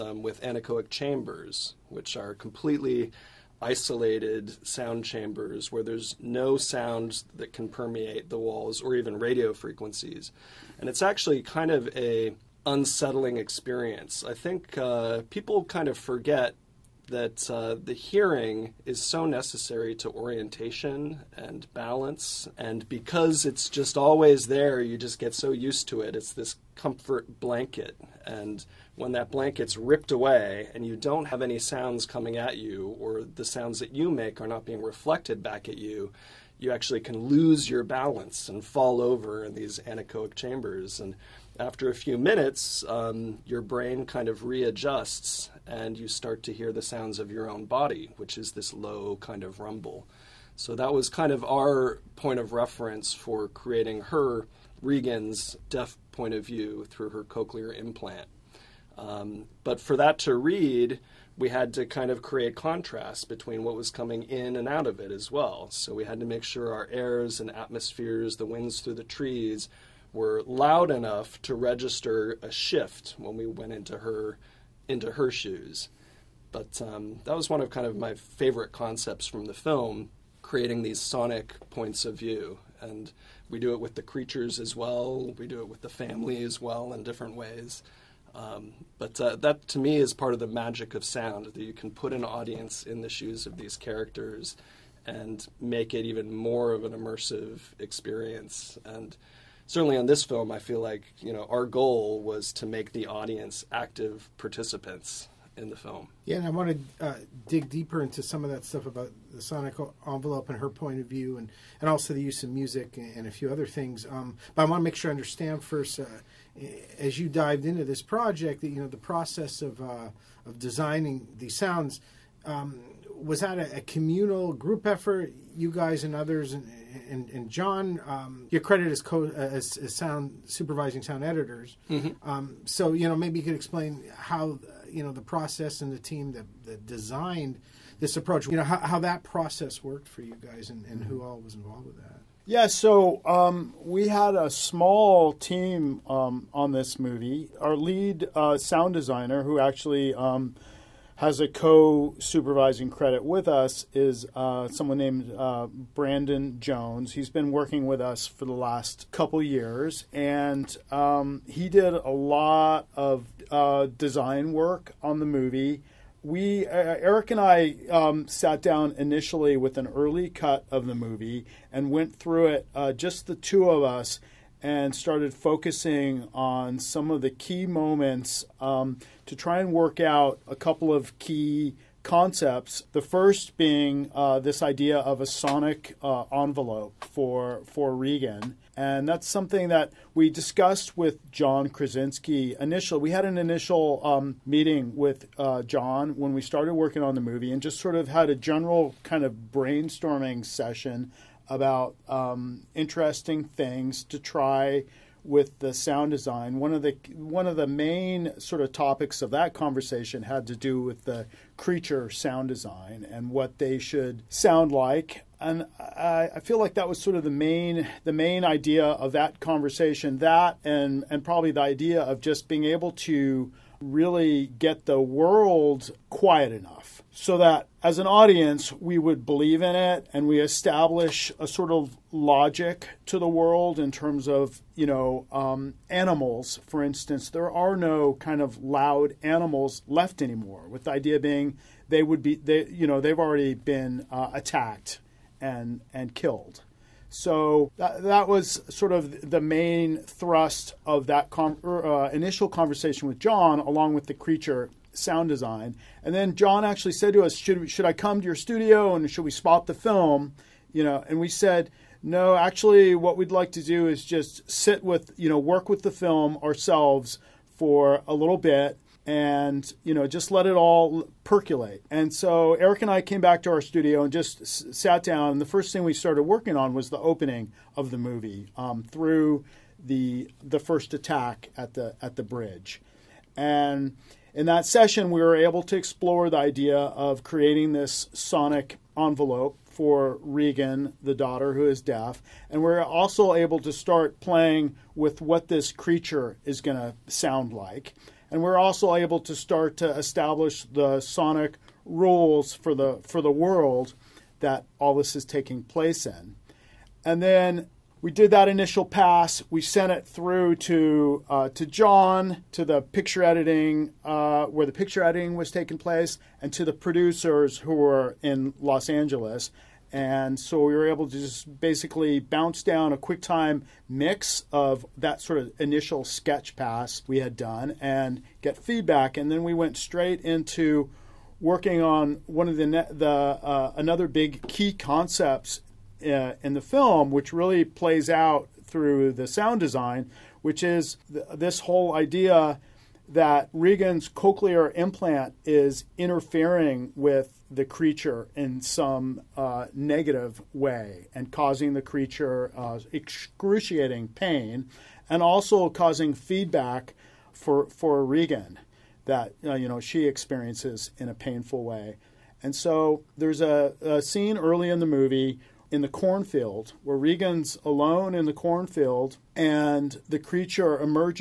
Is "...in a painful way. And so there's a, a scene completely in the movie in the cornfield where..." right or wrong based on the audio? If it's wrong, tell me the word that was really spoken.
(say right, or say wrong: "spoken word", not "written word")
wrong: "early", not "completely".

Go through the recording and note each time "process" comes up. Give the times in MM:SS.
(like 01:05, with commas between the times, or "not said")
01:58, 02:15, 02:19.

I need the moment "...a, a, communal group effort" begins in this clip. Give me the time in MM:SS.
02:03.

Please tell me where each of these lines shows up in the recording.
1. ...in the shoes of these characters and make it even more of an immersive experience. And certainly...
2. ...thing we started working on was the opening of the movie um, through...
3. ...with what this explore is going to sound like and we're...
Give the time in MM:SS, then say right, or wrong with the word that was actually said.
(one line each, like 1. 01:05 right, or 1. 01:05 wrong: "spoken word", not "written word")
1. 01:32 right
2. 04:35 right
3. 04:54 wrong: "creature", not "explore".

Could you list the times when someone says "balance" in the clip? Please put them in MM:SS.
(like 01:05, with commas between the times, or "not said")
00:21, 00:37.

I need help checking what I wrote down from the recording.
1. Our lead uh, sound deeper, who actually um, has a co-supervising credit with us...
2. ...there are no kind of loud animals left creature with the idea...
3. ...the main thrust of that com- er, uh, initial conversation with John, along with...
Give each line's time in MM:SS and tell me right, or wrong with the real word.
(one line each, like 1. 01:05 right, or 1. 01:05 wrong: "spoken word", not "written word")
1. 02:27 wrong: "designer", not "deeper"
2. 03:57 wrong: "anymore", not "creature"
3. 04:09 right.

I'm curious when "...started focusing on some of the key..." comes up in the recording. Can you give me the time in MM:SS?
02:54.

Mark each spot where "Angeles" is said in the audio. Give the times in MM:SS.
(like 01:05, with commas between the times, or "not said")
05:18.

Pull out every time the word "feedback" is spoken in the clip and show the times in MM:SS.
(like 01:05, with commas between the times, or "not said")
05:28, 05:56.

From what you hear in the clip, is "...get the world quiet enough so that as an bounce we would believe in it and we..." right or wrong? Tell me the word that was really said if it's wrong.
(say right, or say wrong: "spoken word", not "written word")
wrong: "audience", not "bounce".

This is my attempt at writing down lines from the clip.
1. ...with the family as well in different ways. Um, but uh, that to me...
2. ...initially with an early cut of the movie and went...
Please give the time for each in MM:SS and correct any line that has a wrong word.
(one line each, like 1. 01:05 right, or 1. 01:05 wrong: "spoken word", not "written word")
1. 01:25 right
2. 02:48 right.